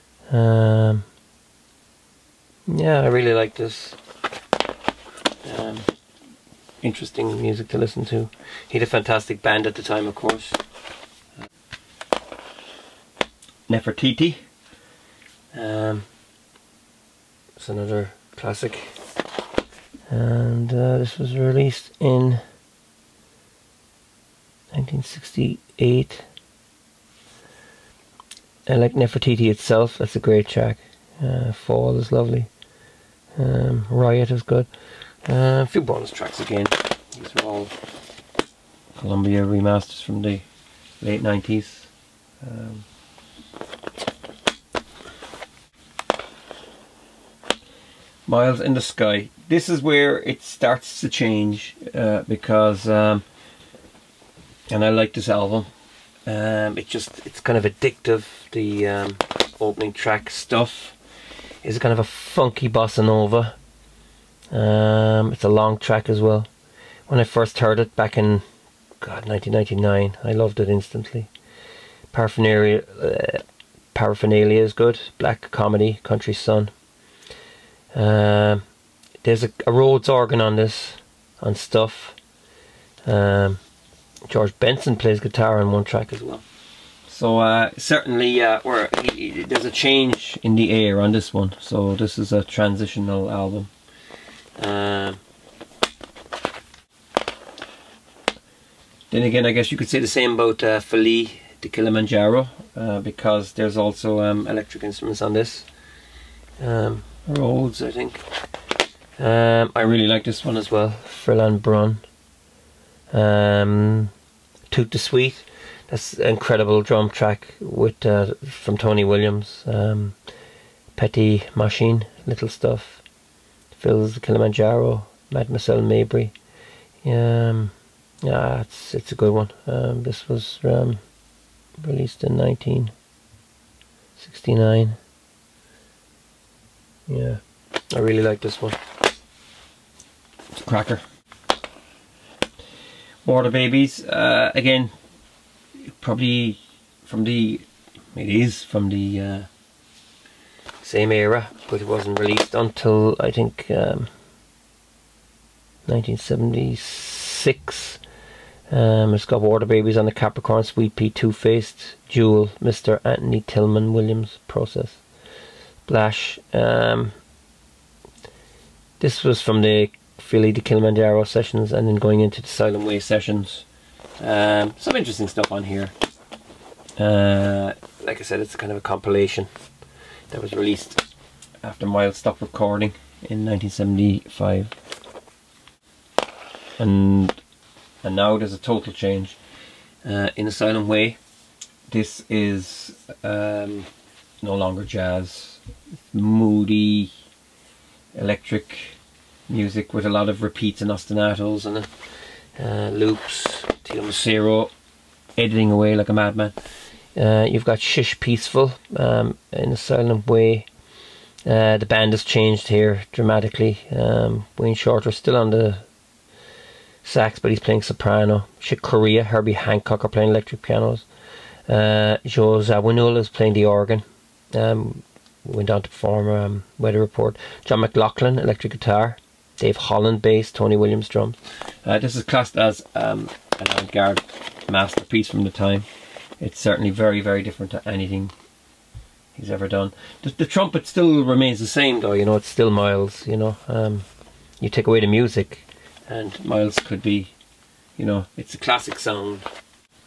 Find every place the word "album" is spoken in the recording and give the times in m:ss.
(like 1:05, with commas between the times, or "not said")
0:55, 1:33.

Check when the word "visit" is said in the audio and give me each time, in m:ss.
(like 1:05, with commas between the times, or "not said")
not said.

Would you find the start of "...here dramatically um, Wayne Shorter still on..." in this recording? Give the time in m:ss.
3:32.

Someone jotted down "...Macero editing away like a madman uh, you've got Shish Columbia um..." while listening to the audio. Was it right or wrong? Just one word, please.
wrong.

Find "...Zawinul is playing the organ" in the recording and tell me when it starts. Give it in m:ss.
3:42.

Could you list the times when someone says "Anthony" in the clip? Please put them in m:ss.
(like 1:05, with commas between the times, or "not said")
2:43.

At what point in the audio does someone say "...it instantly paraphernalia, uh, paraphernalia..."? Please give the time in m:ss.
1:10.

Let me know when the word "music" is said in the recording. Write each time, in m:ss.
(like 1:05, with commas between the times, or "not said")
0:07, 3:19, 4:05.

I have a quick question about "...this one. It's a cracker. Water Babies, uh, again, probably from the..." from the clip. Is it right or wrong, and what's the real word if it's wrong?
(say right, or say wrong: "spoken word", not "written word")
right.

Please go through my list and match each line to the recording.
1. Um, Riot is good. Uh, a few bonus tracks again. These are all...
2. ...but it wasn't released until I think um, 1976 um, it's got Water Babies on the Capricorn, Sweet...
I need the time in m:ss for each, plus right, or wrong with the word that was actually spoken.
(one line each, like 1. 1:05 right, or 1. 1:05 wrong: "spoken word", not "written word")
1. 0:33 right
2. 2:31 right.